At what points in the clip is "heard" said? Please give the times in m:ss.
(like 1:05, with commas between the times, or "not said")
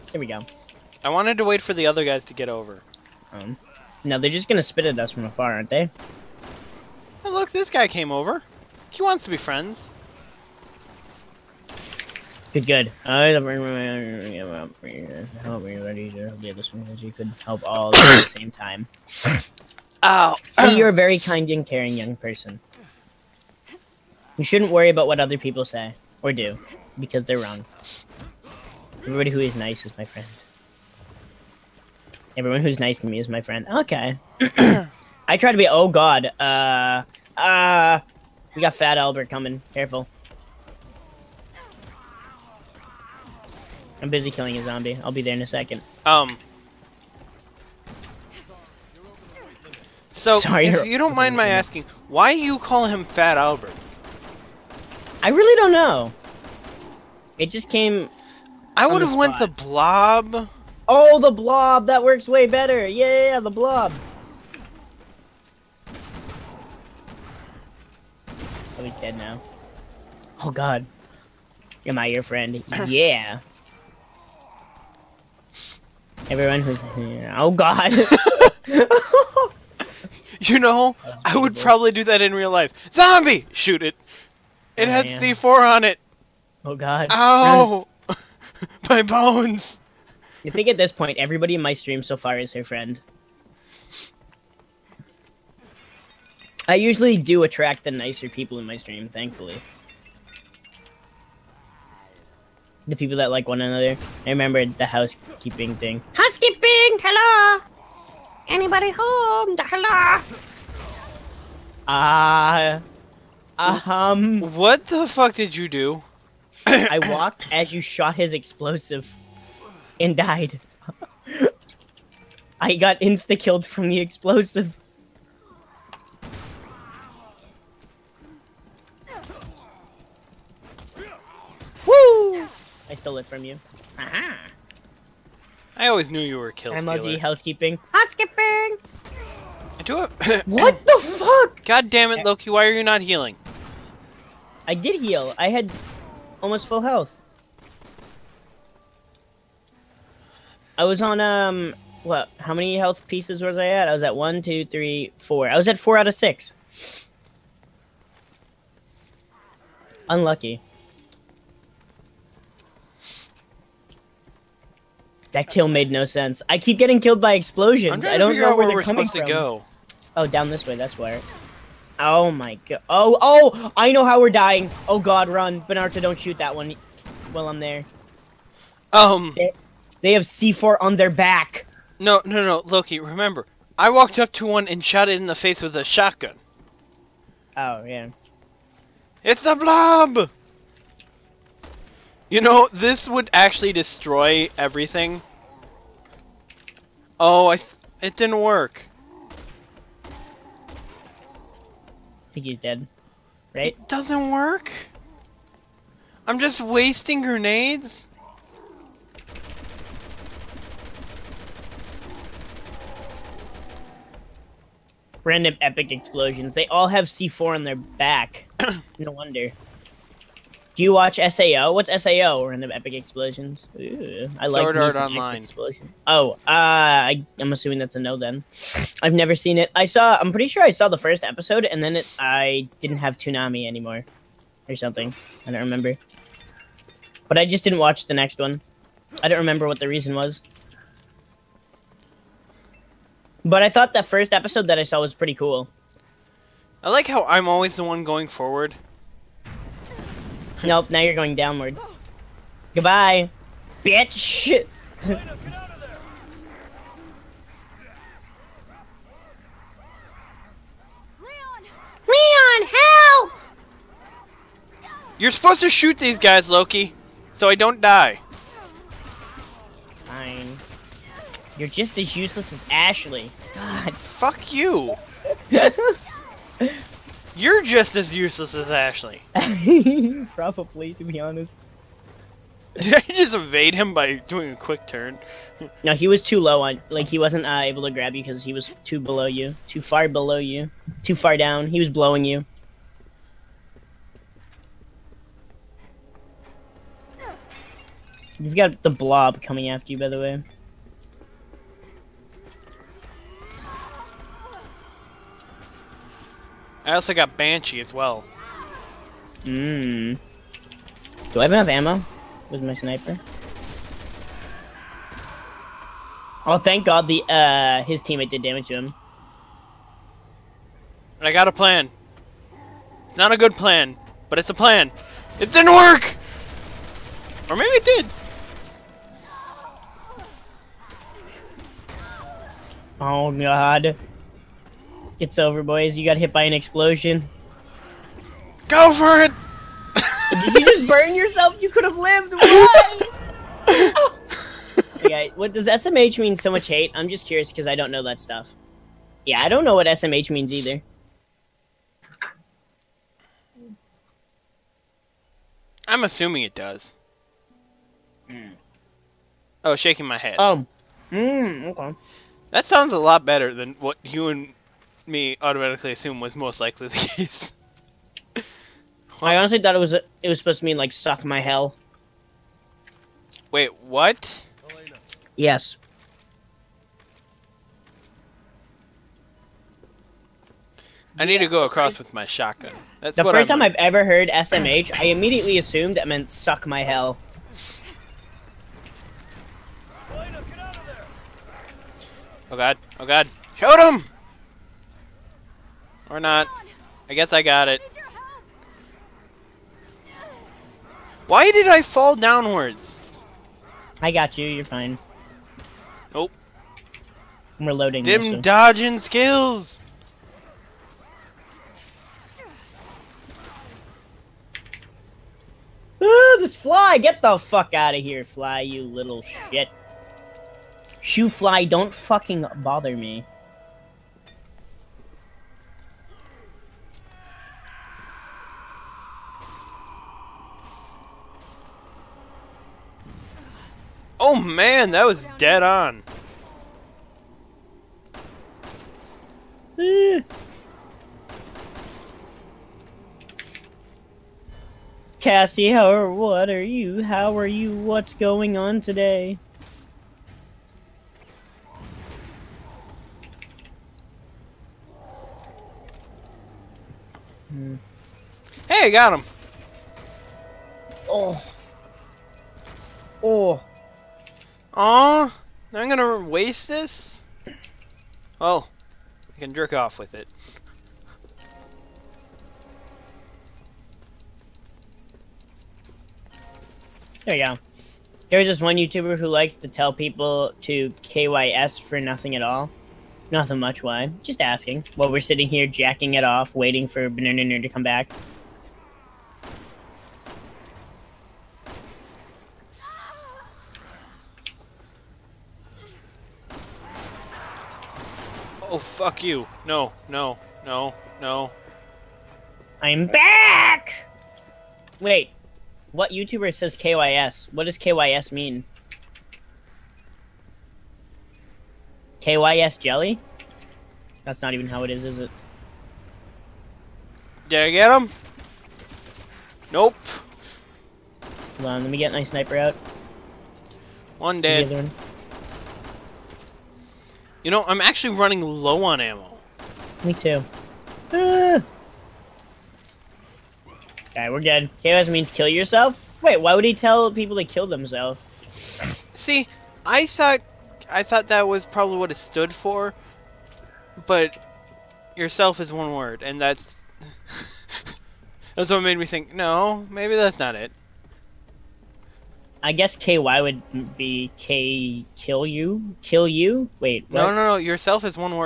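6:24.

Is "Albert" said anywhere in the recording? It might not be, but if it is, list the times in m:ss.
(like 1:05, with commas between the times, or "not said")
0:38, 0:53.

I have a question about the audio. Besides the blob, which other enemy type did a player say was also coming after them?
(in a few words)
Banshee.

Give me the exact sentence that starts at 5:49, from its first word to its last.
Yeah, I don't know what SMH means either.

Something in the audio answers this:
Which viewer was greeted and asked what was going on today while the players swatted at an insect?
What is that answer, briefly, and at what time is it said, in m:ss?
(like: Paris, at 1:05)
Cassie, at 7:25.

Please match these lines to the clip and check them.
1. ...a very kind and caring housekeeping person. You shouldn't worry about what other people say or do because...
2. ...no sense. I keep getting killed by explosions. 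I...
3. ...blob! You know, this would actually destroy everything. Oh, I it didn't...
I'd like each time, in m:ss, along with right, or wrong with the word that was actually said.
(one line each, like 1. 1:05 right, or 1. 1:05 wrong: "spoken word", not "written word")
1. 0:20 wrong: "young", not "housekeeping"
2. 2:45 right
3. 3:09 right.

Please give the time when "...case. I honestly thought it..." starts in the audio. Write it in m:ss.
6:06.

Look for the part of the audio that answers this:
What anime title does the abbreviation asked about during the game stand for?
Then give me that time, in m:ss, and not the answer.
3:44.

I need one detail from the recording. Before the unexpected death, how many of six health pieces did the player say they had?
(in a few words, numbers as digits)
4.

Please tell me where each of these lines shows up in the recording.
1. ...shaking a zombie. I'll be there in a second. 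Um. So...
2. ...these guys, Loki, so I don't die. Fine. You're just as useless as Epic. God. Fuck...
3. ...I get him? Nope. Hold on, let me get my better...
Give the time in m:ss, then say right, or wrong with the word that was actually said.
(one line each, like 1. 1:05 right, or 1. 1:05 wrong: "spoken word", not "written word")
1. 0:44 wrong: "killing", not "shaking"
2. 4:25 wrong: "Ashley", not "Epic"
3. 8:37 wrong: "sniper", not "better".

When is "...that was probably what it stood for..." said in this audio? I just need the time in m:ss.
9:01.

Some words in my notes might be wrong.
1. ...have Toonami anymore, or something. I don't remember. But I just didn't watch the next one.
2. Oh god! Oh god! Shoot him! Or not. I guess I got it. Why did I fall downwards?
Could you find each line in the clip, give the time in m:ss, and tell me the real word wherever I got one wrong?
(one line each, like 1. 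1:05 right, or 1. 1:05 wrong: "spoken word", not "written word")
1. 3:52 right
2. 6:32 right.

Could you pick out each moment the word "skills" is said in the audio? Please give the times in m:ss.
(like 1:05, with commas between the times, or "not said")
6:48.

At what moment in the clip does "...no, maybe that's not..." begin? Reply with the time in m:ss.
9:09.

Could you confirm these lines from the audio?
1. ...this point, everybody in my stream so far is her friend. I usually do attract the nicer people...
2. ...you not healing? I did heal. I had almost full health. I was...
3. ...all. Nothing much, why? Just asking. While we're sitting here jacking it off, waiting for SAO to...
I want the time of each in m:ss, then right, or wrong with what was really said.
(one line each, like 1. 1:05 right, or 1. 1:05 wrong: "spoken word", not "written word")
1. 1:30 right
2. 2:22 right
3. 8:02 wrong: "Banana", not "SAO".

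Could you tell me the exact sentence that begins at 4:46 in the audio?
Like he wasn't uh, able to grab you because he was too below you, too far below you, too far down.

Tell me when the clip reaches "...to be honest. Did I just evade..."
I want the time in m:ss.
4:40.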